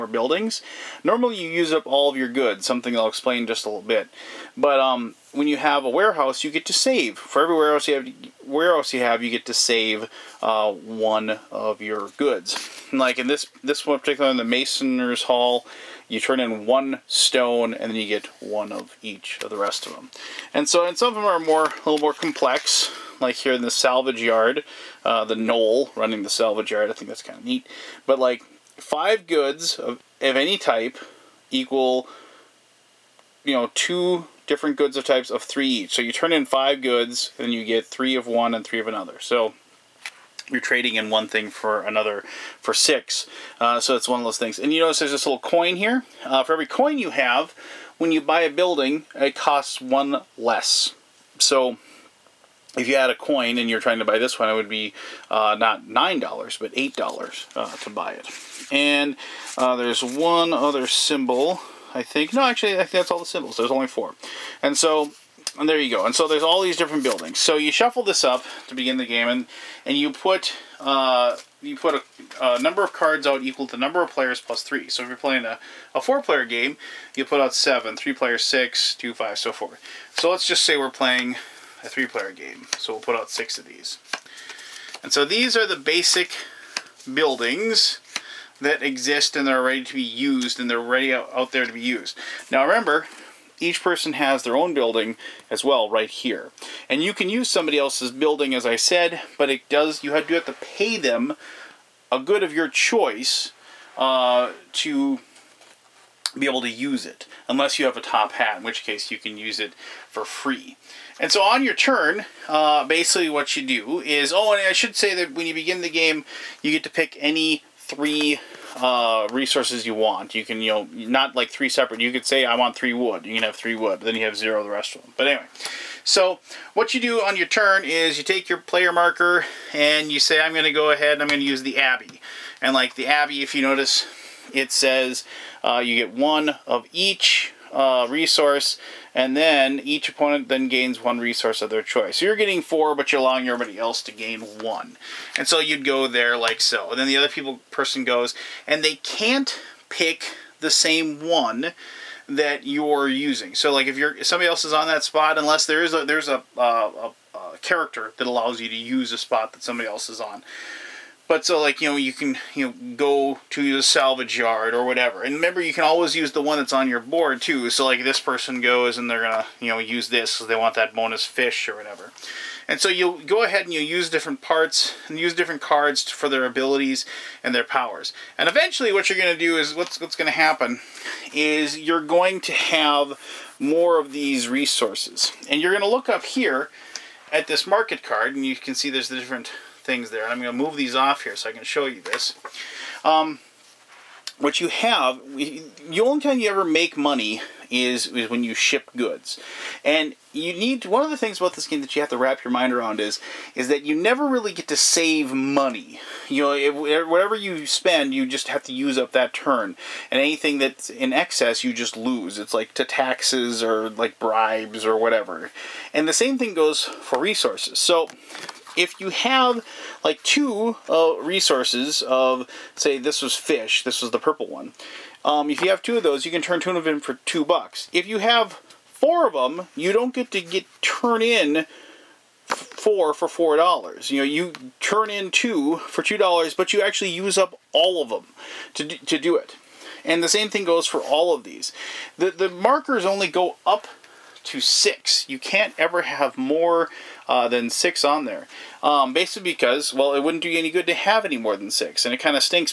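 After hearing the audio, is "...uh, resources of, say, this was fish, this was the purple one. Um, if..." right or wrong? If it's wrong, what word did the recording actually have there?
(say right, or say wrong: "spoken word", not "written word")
right.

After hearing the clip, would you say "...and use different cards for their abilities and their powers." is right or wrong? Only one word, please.
right.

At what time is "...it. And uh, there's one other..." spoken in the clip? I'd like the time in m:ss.
0:58.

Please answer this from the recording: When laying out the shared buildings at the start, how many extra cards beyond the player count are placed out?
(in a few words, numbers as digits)
3.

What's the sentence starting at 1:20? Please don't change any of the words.
So let's just say we're playing a three-player game.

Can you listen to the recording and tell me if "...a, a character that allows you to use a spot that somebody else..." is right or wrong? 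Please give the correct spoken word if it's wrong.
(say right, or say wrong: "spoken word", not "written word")
right.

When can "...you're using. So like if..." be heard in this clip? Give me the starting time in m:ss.
2:32.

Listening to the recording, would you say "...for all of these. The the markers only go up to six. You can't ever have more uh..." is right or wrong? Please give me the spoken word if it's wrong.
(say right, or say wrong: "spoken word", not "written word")
right.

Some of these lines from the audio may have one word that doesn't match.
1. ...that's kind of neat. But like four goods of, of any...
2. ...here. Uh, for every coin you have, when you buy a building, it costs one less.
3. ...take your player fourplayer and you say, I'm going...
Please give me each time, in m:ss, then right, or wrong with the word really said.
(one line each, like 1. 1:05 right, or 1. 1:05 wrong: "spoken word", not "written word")
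1. 0:27 wrong: "five", not "four"
2. 0:45 right
3. 2:08 wrong: "marker", not "fourplayer".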